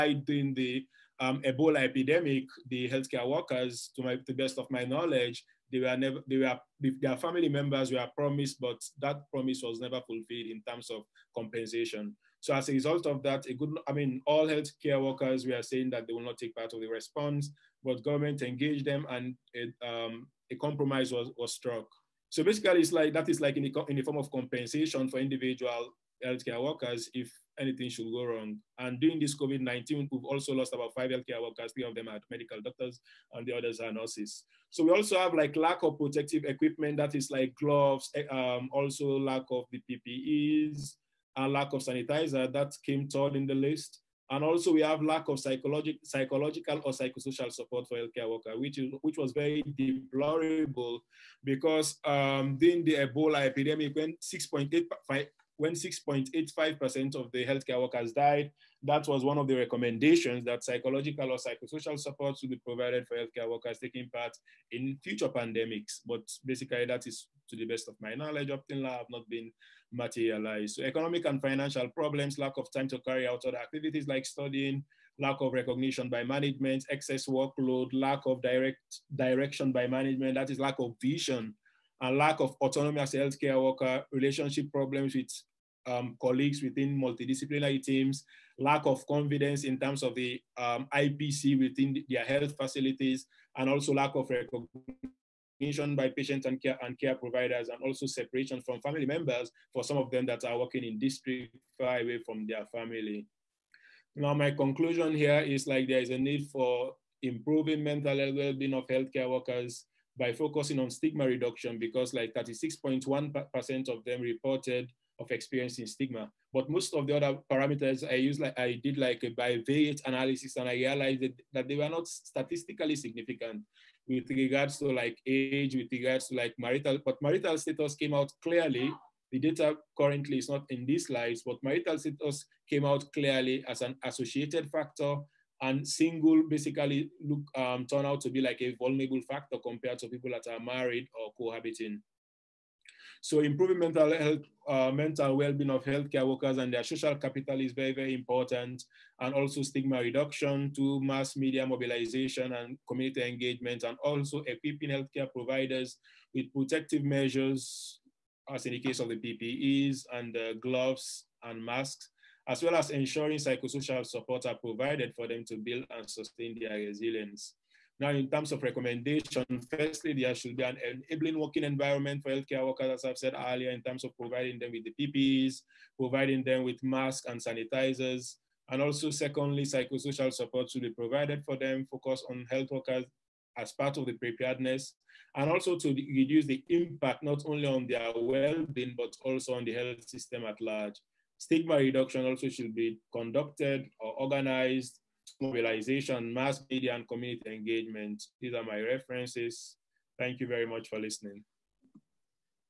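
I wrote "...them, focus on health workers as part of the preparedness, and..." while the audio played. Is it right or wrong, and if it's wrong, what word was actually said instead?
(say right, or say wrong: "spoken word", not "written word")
right.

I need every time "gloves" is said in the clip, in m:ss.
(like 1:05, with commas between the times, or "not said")
0:37, 2:40.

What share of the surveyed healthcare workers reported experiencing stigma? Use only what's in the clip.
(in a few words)
36.1%.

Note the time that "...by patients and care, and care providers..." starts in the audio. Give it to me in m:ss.
1:35.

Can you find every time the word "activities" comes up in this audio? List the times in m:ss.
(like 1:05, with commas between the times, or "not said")
1:13.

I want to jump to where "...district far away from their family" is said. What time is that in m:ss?
1:40.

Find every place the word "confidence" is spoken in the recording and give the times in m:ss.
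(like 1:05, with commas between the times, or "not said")
1:29.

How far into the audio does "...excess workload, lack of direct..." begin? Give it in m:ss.
1:16.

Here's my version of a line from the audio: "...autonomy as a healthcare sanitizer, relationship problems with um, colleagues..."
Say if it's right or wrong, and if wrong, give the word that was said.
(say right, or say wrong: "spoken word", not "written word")
wrong: "worker", not "sanitizer".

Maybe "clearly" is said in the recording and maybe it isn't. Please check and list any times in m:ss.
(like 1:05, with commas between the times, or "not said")
2:08, 2:13.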